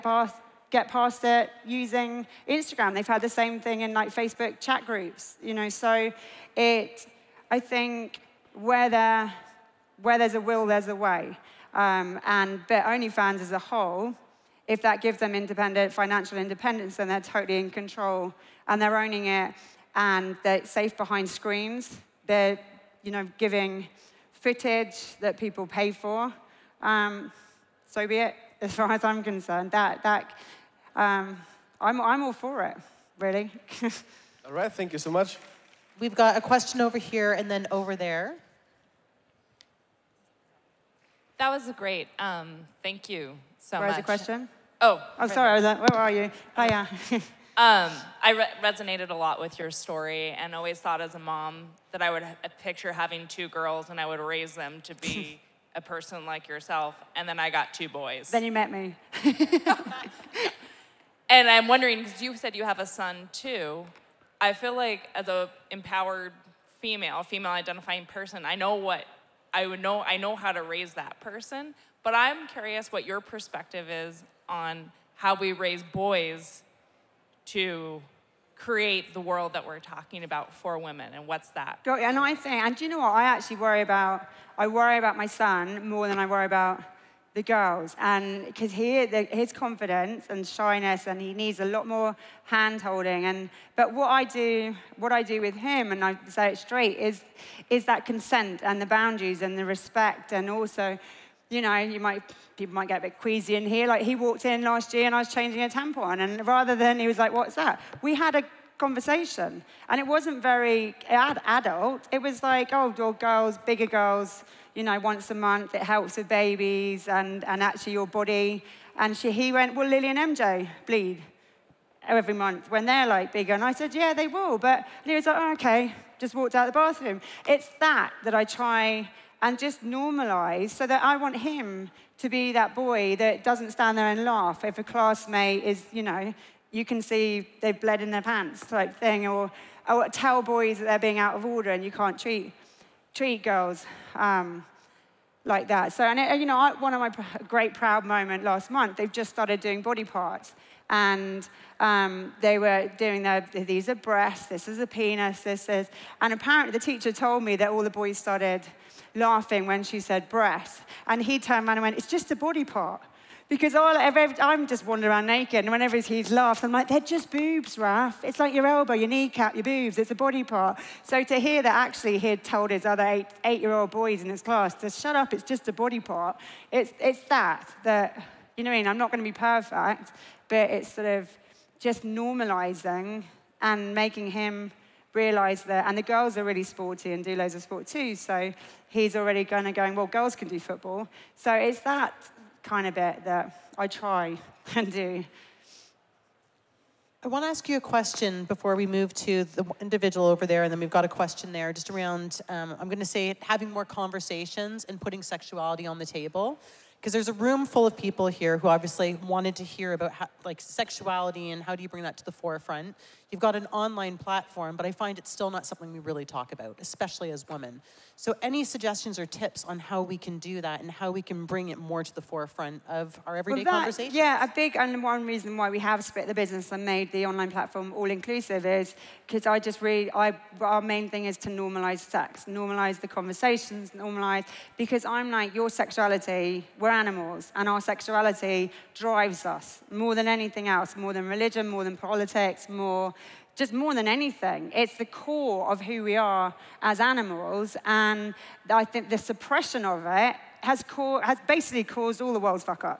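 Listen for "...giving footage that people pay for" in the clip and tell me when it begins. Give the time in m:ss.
0:23.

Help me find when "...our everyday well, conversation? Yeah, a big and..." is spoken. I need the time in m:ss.
3:43.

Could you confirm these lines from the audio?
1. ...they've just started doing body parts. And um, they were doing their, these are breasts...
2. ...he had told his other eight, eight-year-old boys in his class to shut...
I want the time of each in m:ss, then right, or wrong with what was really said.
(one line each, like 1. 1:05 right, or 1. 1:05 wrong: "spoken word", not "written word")
1. 2:28 right
2. 2:52 right.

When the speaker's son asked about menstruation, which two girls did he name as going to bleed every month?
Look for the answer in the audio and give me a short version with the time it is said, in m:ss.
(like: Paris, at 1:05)
Lily and MJ, at 1:59.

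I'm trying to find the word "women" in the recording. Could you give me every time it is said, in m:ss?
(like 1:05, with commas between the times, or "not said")
1:20, 3:37.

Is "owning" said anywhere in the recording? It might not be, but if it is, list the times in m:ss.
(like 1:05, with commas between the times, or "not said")
0:18.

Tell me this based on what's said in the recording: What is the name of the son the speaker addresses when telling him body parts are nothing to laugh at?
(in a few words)
Raph.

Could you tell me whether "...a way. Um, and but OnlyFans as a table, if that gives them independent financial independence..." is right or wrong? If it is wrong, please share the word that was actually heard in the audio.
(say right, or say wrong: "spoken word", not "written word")
wrong: "whole", not "table".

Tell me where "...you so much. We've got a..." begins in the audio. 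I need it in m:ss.
0:34.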